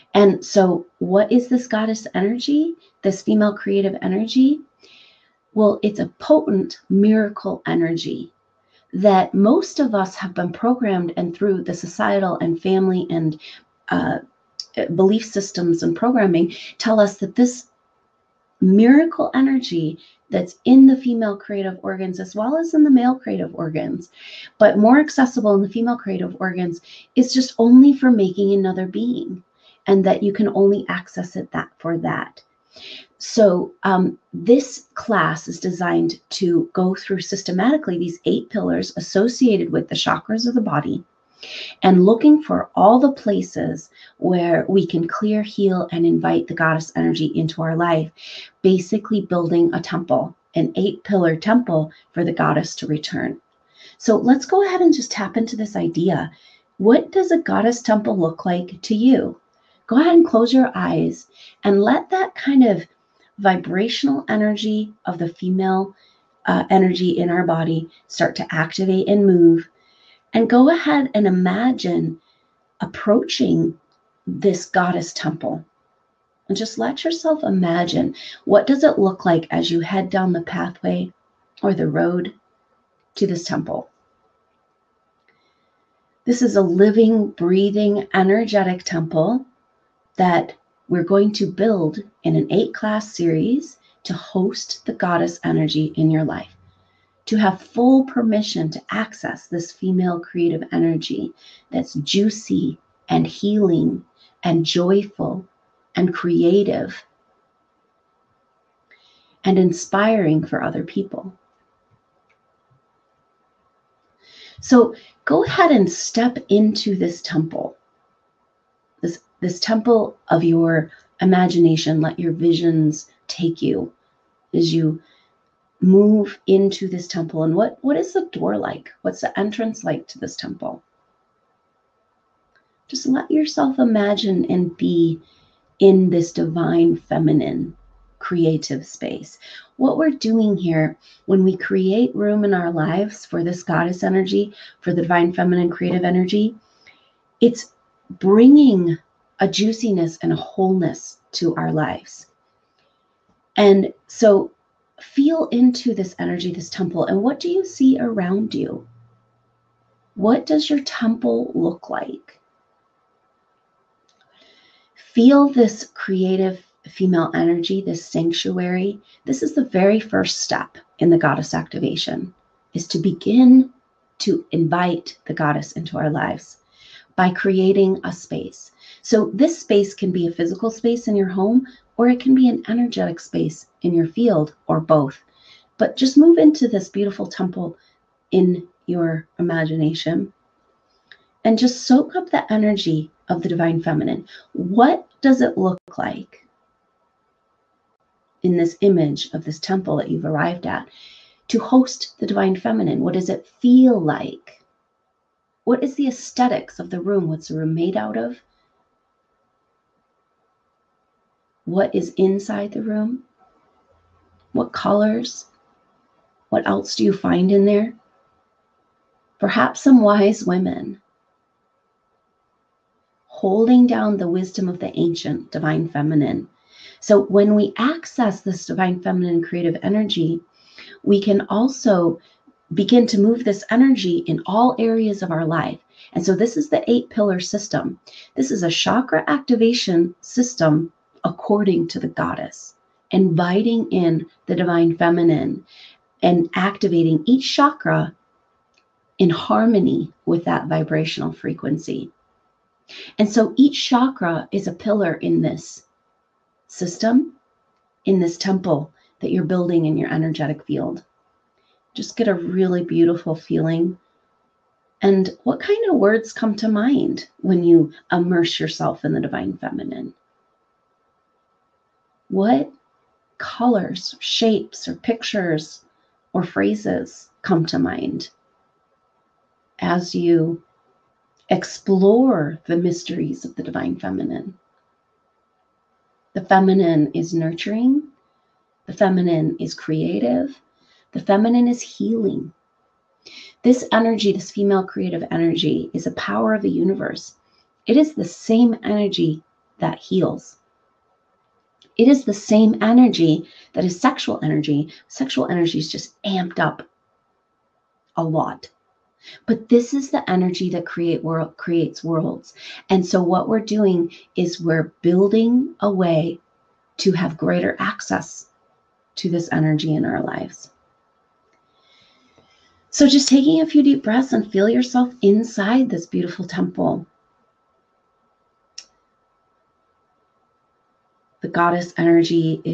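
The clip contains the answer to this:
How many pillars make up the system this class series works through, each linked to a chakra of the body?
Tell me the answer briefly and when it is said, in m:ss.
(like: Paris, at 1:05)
8, at 0:38.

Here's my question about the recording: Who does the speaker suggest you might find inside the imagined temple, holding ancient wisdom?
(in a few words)
Wise women.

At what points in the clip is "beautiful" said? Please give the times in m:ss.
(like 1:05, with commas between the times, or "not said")
3:06, 4:22, 5:26.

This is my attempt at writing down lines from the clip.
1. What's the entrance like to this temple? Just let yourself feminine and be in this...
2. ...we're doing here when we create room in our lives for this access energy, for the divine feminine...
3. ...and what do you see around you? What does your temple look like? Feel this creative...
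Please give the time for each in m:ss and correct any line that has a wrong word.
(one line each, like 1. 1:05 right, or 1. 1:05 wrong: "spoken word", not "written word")
1. 2:09 wrong: "imagine", not "feminine"
2. 2:19 wrong: "goddess", not "access"
3. 2:37 right.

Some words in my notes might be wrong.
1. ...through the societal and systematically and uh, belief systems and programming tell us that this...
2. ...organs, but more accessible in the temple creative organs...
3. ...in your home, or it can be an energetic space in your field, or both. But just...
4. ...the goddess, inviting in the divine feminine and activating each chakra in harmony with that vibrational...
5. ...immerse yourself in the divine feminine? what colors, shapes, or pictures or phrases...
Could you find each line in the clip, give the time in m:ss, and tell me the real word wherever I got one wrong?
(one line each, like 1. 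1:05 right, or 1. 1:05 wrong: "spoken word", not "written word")
1. 0:11 wrong: "family", not "systematically"
2. 0:23 wrong: "female", not "temple"
3. 3:01 right
4. 4:01 right
5. 4:28 right.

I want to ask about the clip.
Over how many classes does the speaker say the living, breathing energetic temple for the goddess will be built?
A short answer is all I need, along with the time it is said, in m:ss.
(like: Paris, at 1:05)
8, at 1:32.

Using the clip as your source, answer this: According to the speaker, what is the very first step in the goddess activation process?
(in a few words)
Creating a space.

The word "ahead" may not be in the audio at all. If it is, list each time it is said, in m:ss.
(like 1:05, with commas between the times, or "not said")
0:54, 0:59, 1:10, 1:55.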